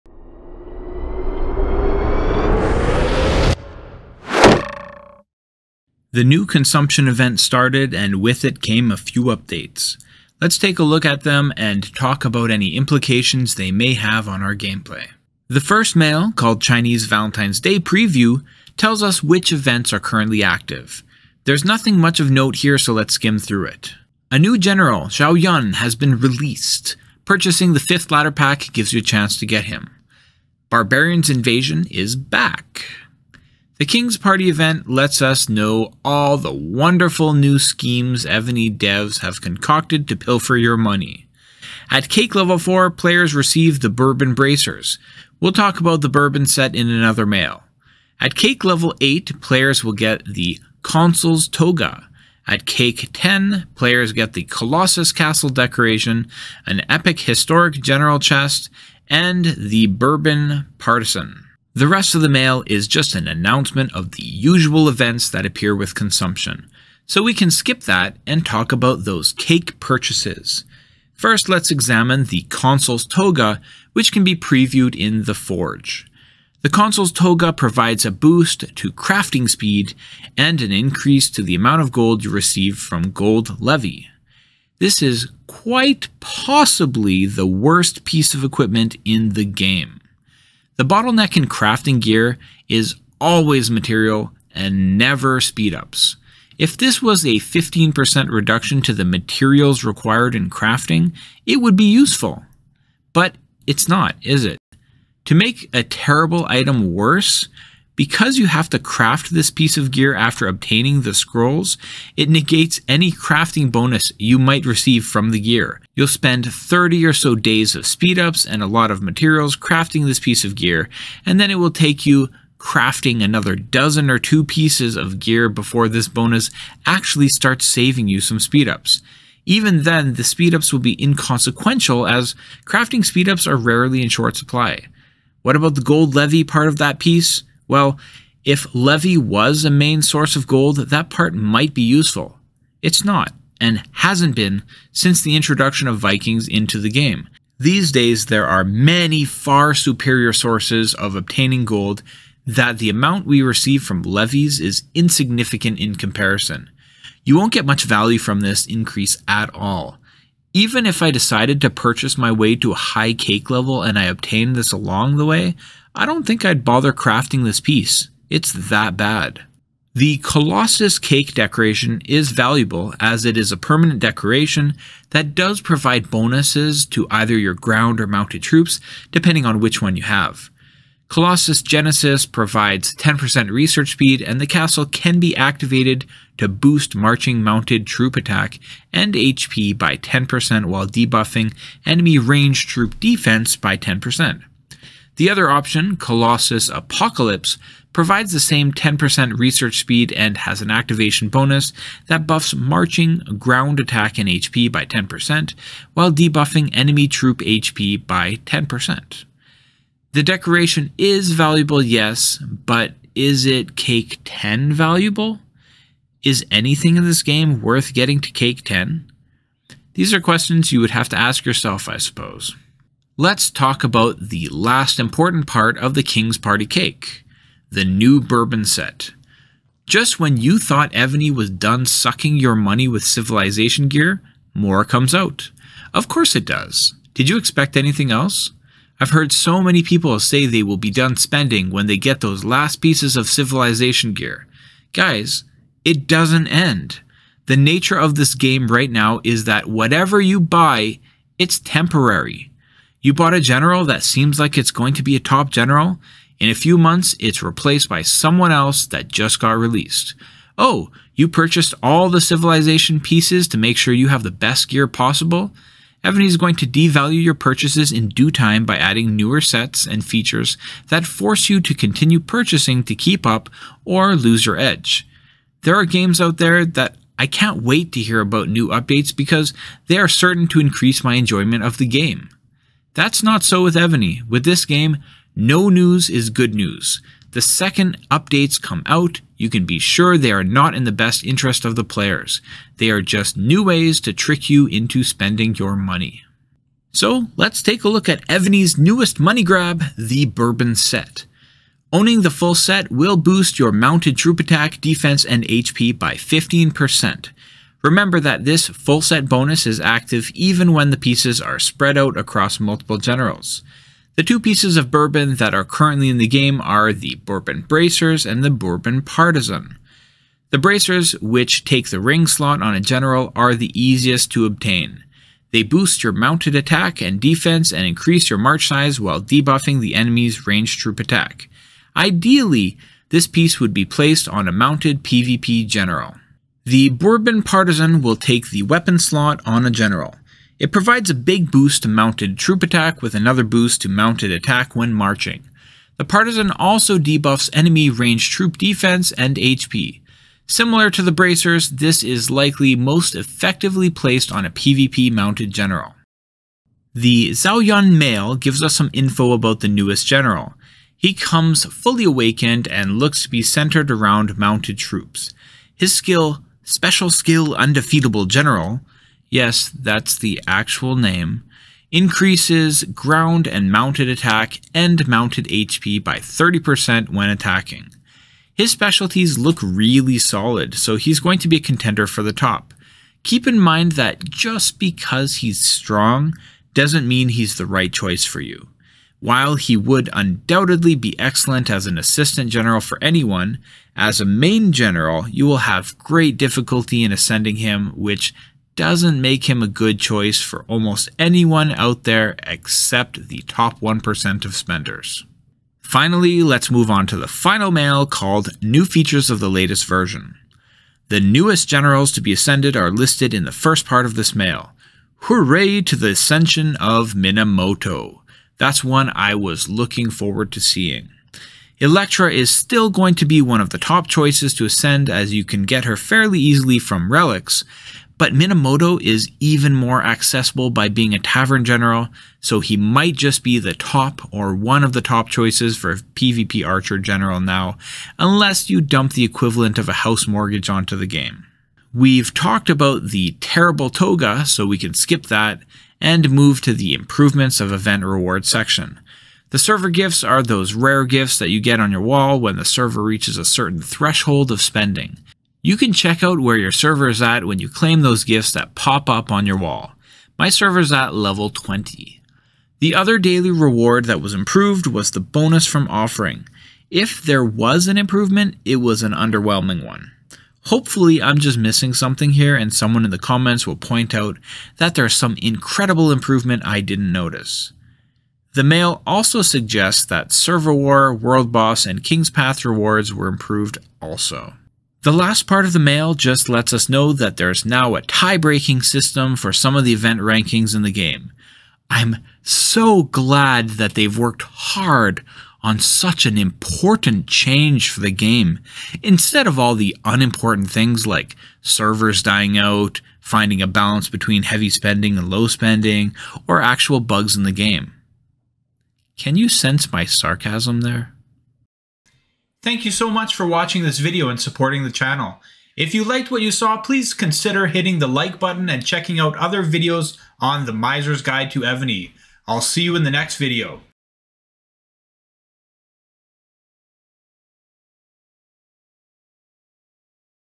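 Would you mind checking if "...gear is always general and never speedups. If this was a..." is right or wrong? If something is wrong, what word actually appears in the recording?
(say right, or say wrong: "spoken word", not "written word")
wrong: "material", not "general".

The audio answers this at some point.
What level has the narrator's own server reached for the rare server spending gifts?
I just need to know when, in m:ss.
7:41.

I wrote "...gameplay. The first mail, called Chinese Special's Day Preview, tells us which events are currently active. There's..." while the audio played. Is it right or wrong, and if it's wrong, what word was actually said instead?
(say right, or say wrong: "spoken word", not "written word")
wrong: "Valentine", not "Special".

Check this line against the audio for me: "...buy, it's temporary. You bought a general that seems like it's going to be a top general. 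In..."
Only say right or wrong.
right.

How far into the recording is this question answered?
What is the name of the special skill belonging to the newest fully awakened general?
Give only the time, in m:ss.
6:07.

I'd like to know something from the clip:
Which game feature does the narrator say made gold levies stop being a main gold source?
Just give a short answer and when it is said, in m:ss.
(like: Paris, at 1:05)
Vikings, at 2:25.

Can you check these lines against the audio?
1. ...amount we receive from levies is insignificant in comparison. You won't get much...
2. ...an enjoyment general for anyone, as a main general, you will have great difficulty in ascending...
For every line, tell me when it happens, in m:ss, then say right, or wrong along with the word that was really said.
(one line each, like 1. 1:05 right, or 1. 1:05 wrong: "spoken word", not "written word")
1. 2:32 right
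2. 6:31 wrong: "assistant", not "enjoyment".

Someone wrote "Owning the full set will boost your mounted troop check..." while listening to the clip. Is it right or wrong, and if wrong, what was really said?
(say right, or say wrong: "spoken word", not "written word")
wrong: "attack", not "check".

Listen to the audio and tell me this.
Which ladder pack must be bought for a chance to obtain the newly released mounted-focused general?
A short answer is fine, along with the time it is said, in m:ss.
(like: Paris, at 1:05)
5th, at 0:27.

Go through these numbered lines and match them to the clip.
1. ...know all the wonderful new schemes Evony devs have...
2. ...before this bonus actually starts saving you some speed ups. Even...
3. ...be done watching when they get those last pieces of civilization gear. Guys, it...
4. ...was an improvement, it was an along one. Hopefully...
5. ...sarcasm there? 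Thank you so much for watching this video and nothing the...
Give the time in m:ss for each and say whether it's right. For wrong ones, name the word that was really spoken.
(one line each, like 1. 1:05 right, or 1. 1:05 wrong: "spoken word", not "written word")
1. 0:35 right
2. 2:05 right
3. 4:00 wrong: "spending", not "watching"
4. 7:47 wrong: "underwhelming", not "along"
5. 8:30 wrong: "supporting", not "nothing".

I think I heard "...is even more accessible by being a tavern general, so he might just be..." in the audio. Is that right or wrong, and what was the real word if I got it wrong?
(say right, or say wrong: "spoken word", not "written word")
right.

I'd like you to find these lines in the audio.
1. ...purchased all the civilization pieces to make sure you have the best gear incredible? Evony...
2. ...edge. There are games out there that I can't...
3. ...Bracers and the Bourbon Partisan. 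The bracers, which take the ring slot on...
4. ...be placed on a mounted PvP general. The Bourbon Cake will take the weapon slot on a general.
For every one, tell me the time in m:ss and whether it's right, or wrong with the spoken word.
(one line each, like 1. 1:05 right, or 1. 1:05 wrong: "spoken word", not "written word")
1. 4:21 wrong: "possible", not "incredible"
2. 4:34 right
3. 5:17 right
4. 5:33 wrong: "Partisan", not "Cake".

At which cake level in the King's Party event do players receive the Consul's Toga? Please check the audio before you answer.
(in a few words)
8.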